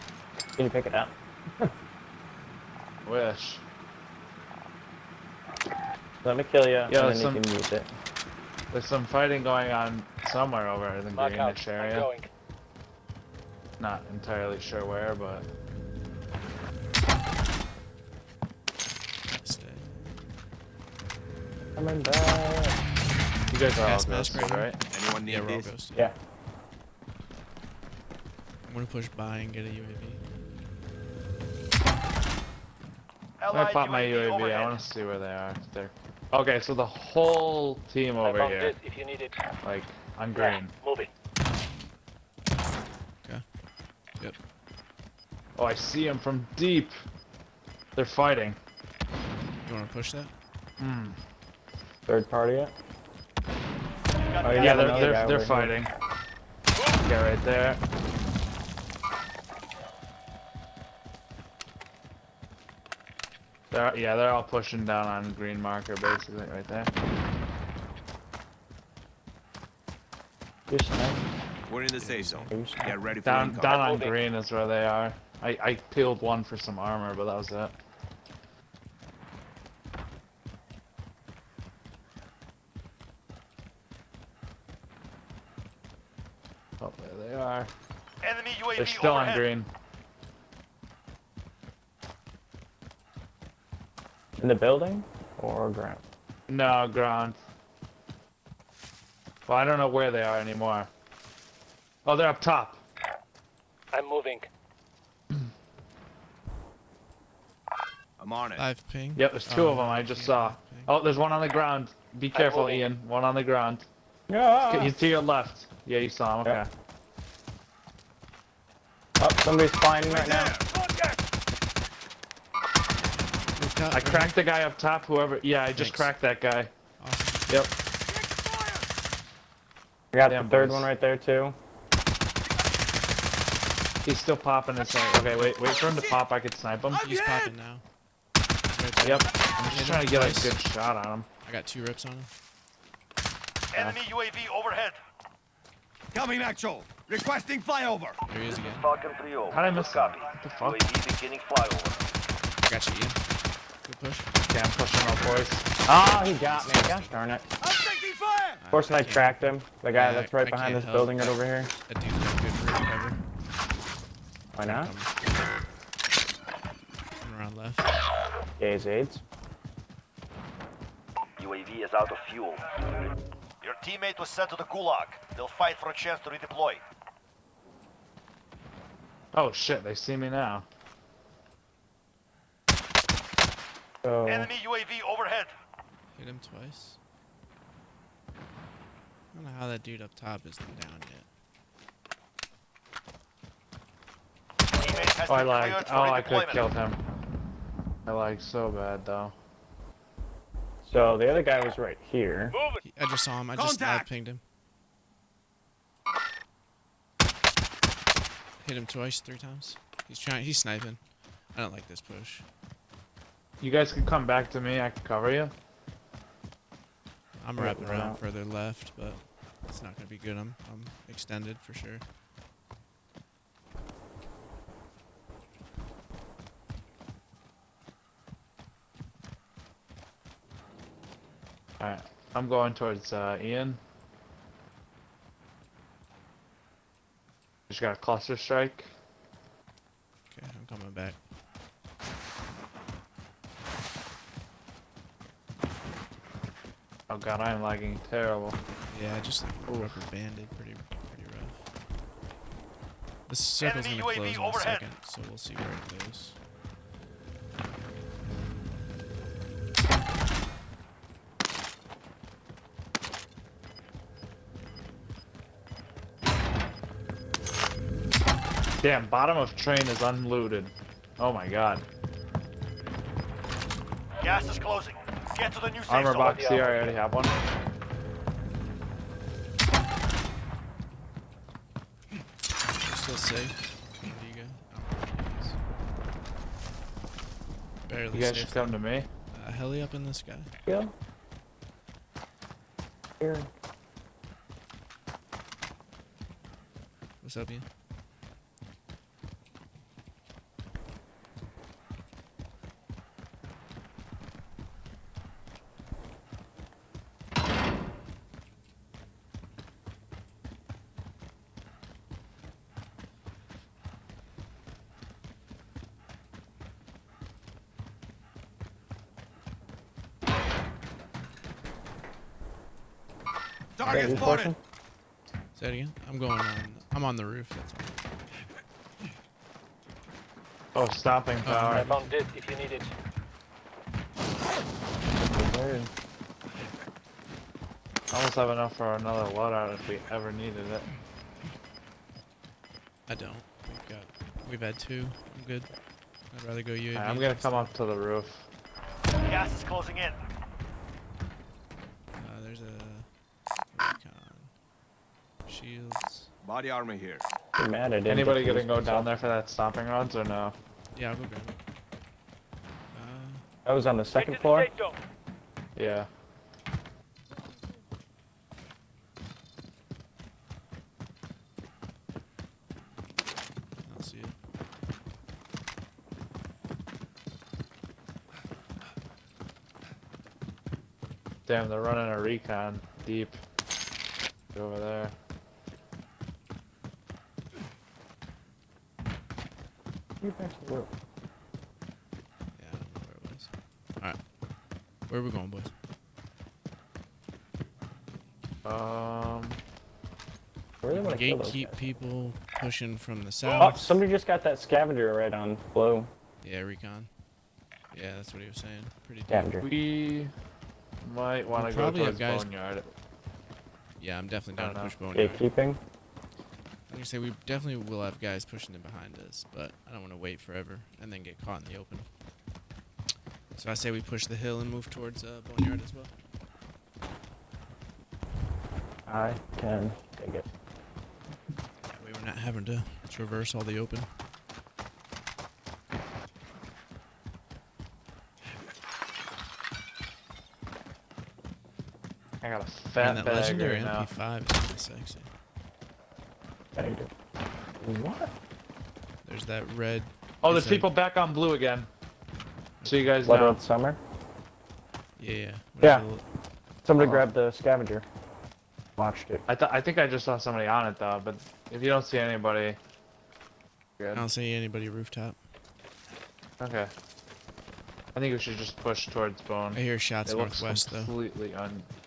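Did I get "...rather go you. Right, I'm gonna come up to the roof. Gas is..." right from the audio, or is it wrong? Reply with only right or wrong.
right.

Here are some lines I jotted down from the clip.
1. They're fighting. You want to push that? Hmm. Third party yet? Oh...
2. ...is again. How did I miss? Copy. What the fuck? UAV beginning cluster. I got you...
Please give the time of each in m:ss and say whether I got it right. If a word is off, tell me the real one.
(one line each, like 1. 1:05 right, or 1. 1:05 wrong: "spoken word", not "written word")
1. 0:47 right
2. 2:28 wrong: "flyover", not "cluster".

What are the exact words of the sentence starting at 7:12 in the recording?
we are not having to traverse all the open.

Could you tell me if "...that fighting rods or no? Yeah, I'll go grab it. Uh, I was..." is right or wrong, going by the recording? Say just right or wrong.
wrong.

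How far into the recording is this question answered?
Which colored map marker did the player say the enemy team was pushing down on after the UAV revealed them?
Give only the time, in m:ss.
1:05.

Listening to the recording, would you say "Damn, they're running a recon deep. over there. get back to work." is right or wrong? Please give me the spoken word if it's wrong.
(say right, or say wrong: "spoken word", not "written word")
right.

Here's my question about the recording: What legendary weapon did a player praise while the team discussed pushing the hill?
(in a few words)
MP5.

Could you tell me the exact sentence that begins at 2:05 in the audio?
Yeah, I just cracked that guy.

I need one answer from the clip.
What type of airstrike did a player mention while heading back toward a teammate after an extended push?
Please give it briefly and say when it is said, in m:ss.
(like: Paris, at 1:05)
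Cluster strike, at 3:58.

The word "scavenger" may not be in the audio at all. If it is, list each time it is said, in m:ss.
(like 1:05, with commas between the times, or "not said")
6:44, 6:49, 7:37.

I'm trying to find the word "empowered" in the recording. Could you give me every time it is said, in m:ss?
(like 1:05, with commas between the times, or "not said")
not said.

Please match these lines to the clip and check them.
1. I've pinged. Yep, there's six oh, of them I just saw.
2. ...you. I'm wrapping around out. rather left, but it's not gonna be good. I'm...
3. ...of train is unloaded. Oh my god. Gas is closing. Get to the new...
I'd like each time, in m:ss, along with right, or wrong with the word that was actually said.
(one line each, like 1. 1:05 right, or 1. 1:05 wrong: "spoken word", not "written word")
1. 1:48 wrong: "two", not "six"
2. 3:35 wrong: "further", not "rather"
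3. 4:29 right.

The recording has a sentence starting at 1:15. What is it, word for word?
I, I peeled one for some armor, but that was it.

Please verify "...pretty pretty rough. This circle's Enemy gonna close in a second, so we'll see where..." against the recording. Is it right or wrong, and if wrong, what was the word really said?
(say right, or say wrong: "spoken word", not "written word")
right.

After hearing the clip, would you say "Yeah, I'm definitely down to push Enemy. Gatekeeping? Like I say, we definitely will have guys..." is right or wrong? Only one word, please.
wrong.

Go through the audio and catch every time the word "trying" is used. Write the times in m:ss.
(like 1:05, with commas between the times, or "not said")
2:19, 3:30.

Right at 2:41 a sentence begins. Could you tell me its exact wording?
That dude's not good for recovery.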